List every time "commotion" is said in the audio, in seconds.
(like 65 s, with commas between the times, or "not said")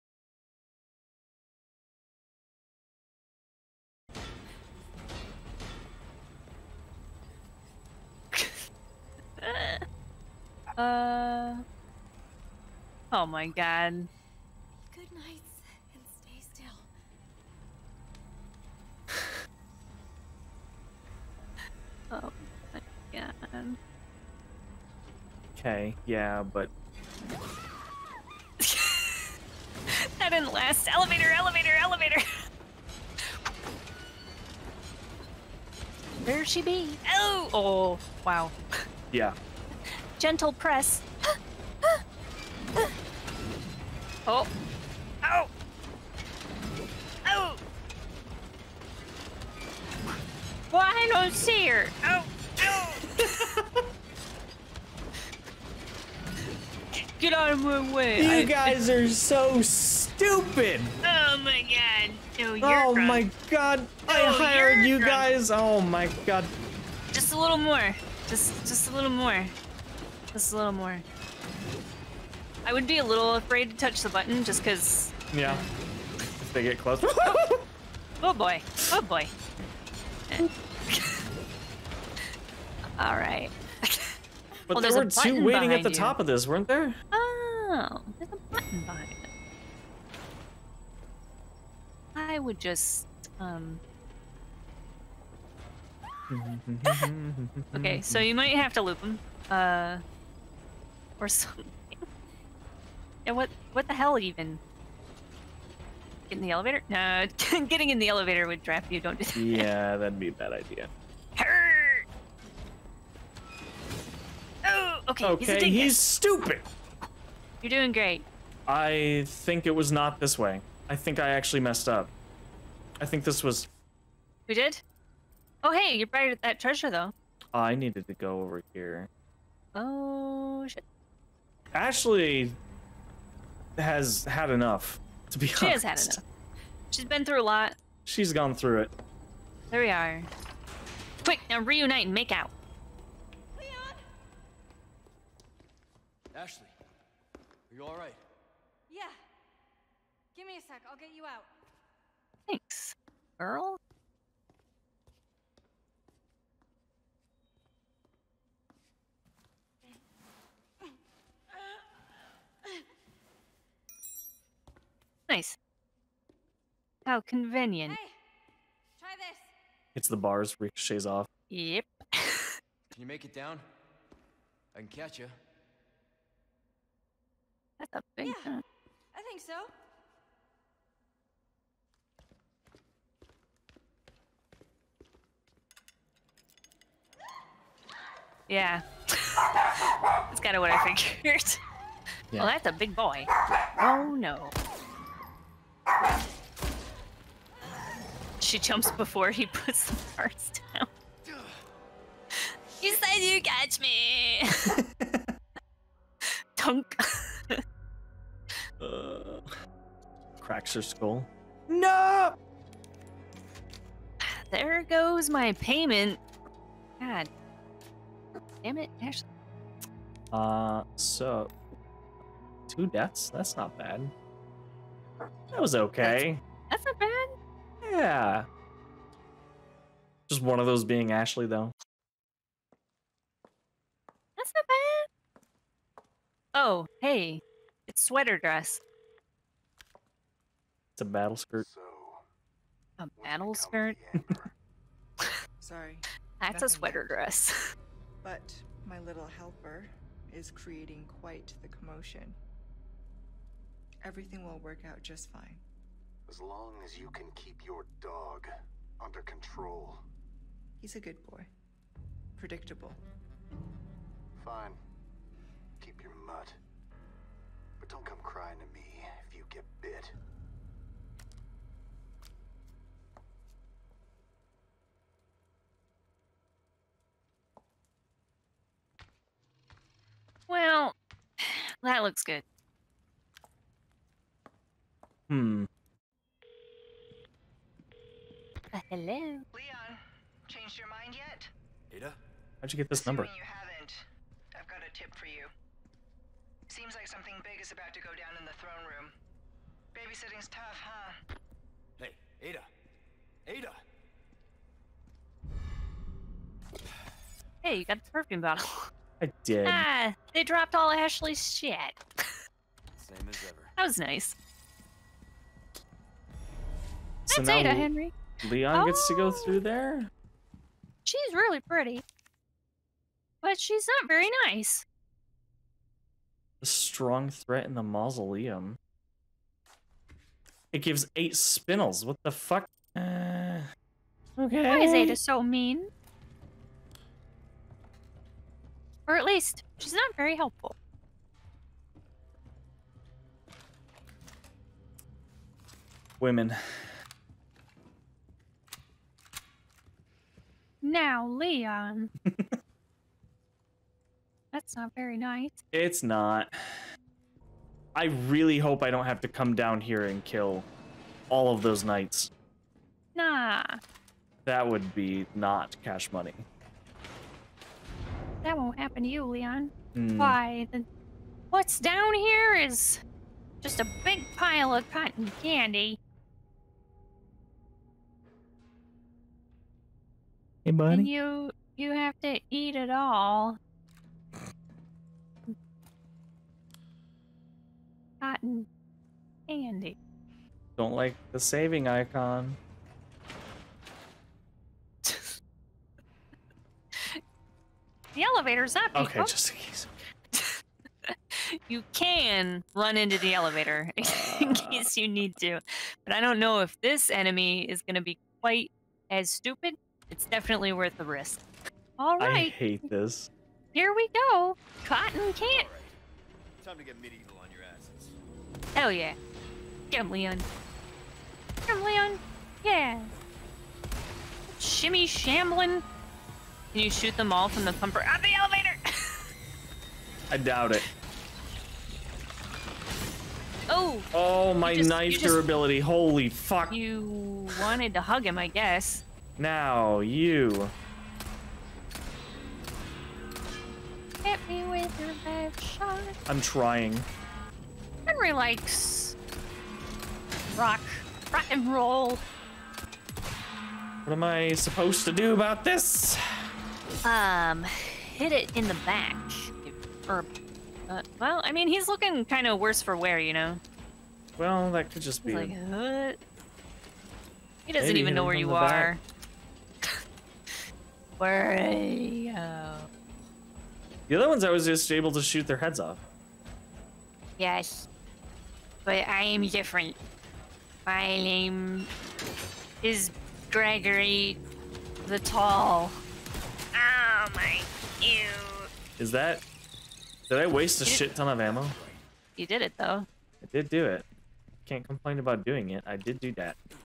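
251 s.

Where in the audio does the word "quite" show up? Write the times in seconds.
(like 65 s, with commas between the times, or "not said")
251 s, 408 s.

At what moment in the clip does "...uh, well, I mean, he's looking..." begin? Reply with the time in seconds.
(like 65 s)
460 s.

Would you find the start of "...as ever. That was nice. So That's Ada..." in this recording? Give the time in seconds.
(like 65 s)
313 s.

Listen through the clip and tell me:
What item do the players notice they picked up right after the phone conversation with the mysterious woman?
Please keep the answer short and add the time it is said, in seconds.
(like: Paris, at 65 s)
perfume bottle, at 308 s.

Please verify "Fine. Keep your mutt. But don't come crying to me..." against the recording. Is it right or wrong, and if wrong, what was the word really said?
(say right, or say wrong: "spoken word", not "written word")
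right.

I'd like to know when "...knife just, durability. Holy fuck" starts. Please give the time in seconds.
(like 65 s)
434 s.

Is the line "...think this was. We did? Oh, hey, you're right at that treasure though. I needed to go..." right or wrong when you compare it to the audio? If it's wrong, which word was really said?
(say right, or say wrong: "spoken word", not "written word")
right.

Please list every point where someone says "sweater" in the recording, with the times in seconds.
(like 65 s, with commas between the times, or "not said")
238 s, 246 s.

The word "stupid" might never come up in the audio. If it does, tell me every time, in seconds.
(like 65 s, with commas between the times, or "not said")
59 s, 115 s, 409 s.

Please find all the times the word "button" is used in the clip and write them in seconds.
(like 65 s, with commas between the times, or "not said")
74 s, 88 s.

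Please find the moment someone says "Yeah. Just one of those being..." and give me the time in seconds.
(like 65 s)
227 s.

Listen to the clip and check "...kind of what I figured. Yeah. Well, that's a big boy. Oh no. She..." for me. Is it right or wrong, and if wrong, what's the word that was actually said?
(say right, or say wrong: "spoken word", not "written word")
right.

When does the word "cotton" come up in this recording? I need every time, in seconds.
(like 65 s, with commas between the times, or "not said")
374 s, 388 s, 414 s.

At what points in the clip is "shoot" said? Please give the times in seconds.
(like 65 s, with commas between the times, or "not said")
426 s, 475 s.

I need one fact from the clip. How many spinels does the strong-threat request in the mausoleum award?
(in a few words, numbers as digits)
8.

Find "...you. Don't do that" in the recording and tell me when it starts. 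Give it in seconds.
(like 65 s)
108 s.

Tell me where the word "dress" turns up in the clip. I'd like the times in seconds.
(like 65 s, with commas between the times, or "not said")
238 s, 247 s.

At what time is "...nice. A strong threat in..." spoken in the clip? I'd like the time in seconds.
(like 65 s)
324 s.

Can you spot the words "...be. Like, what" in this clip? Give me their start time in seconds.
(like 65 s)
465 s.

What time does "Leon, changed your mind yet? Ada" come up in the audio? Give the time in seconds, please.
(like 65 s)
288 s.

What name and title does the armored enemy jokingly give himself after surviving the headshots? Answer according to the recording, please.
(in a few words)
Gregory the Tall.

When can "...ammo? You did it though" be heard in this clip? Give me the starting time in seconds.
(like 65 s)
491 s.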